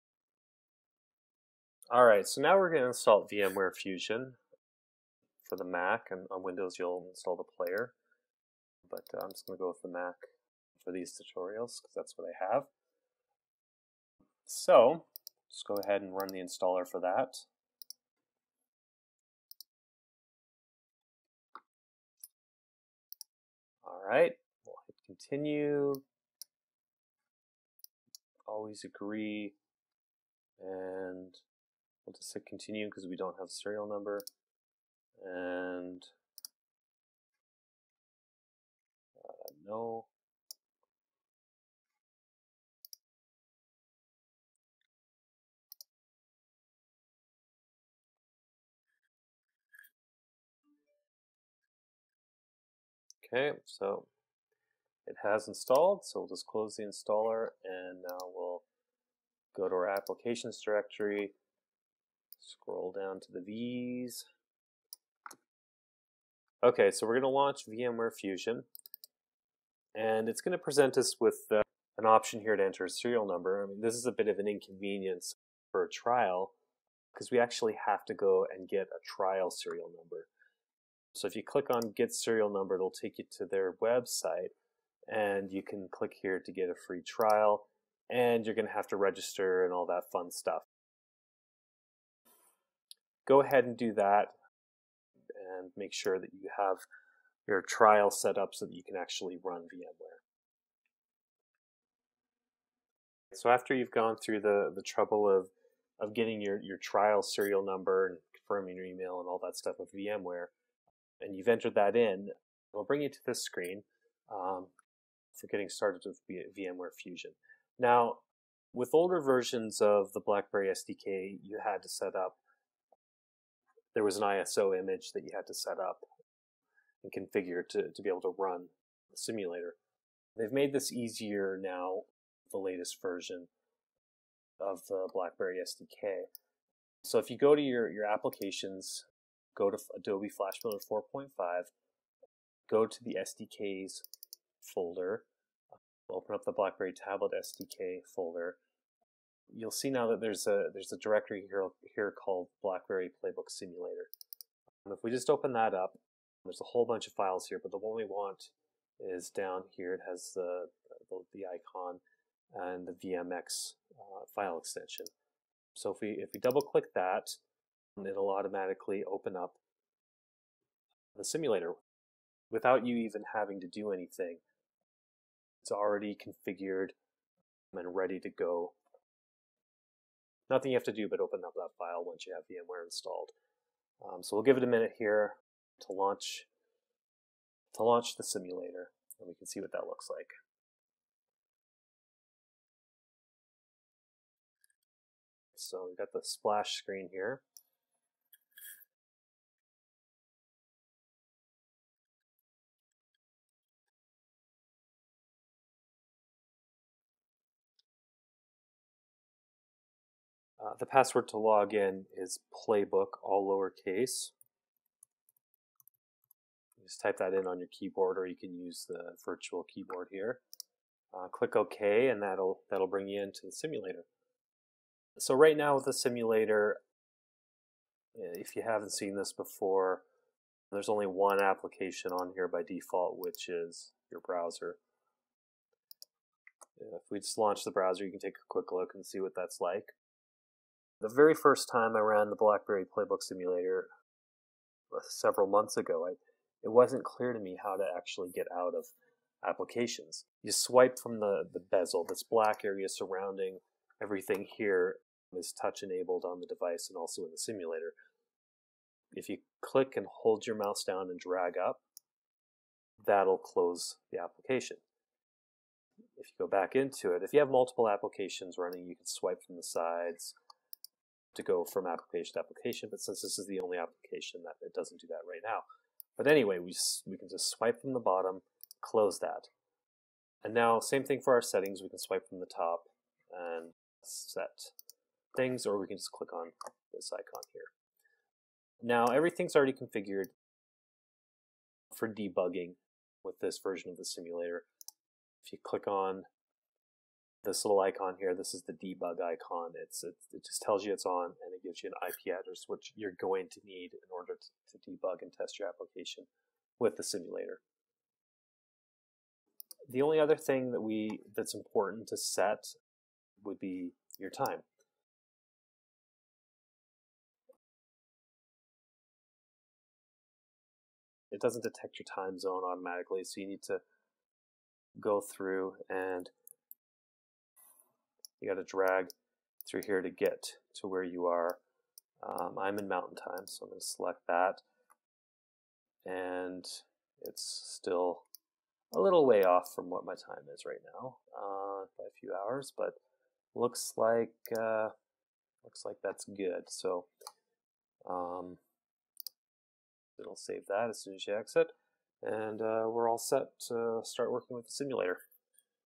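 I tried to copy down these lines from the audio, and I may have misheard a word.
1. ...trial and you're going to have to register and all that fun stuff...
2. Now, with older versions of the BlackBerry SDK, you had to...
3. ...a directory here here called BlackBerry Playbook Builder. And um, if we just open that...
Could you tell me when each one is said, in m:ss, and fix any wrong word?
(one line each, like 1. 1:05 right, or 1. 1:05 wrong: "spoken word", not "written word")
1. 1:27 right
2. 1:57 right
3. 2:30 wrong: "Simulator", not "Builder".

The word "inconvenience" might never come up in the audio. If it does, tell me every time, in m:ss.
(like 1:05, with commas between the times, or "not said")
1:14.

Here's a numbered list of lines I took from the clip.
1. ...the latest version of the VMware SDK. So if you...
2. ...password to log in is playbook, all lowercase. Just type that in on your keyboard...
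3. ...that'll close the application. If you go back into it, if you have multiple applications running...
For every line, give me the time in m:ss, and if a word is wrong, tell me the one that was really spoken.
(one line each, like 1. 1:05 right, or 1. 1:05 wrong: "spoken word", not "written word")
1. 2:12 wrong: "BlackBerry", not "VMware"
2. 3:30 right
3. 4:23 right.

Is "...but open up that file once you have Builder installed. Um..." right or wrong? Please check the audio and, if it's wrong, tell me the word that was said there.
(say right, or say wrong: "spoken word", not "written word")
wrong: "VMware", not "Builder".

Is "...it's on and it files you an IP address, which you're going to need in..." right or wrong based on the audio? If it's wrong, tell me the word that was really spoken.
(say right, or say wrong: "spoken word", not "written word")
wrong: "gives", not "files".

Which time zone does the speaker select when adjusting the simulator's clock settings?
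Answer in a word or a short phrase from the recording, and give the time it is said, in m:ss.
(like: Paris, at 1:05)
Mountain time, at 5:32.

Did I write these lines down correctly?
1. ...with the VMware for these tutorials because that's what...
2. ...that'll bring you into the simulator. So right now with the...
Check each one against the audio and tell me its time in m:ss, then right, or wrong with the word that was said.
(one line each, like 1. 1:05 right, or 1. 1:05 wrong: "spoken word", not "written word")
1. 0:09 wrong: "Mac", not "VMware"
2. 3:42 right.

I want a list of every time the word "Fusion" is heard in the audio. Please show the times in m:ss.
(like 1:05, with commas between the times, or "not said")
0:03, 1:08, 1:57.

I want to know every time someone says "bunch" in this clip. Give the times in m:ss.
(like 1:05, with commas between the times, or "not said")
2:36.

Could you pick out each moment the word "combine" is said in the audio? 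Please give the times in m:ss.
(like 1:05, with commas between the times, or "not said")
not said.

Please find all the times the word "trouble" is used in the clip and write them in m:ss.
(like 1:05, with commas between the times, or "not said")
1:44.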